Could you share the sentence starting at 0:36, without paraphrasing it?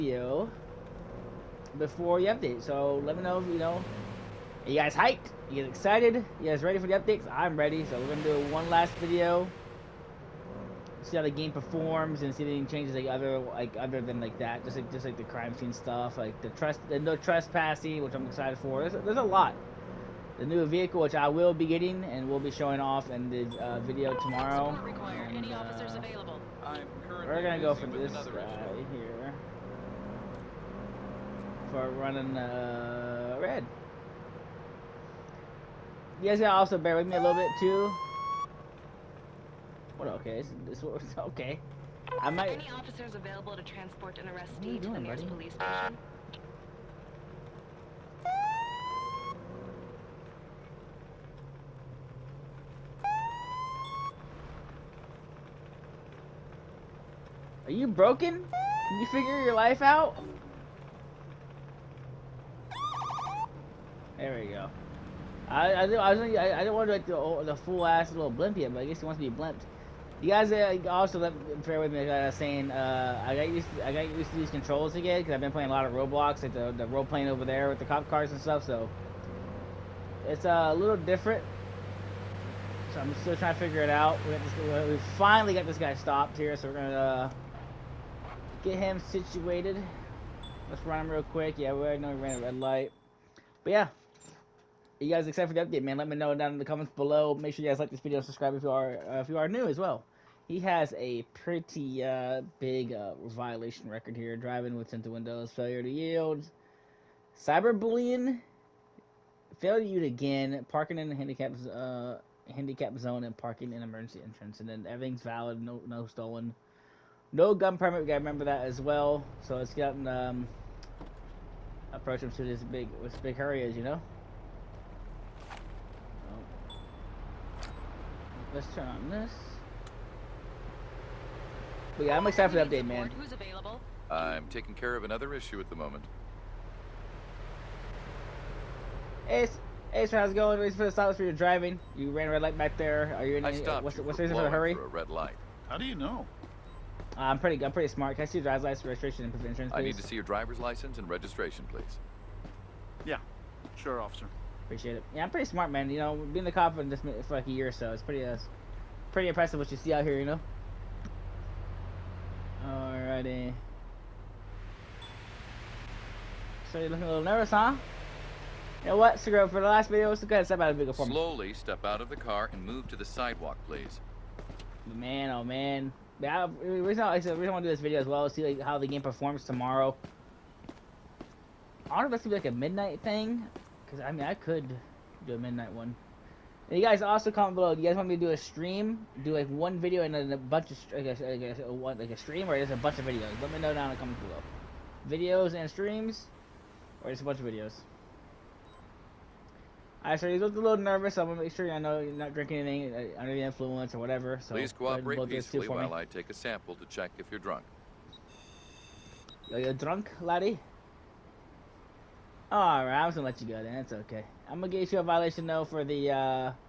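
You guys gotta also bear with me a little bit too.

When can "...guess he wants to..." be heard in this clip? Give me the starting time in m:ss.
1:08.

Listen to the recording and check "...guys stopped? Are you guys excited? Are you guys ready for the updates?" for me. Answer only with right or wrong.
wrong.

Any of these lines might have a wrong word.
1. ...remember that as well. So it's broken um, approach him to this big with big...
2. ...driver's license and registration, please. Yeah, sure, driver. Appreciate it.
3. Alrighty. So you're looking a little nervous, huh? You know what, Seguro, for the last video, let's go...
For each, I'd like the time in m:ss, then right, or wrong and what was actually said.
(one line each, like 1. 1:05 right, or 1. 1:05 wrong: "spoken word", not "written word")
1. 1:58 wrong: "gotten", not "broken"
2. 2:30 wrong: "officer", not "driver"
3. 2:42 right.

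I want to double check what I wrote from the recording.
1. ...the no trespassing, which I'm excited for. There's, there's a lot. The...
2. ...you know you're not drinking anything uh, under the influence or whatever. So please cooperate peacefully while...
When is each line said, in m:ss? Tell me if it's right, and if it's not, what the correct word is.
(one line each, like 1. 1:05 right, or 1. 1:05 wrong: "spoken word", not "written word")
1. 0:16 right
2. 3:21 right.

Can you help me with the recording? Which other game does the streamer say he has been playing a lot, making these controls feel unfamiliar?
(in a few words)
Roblox.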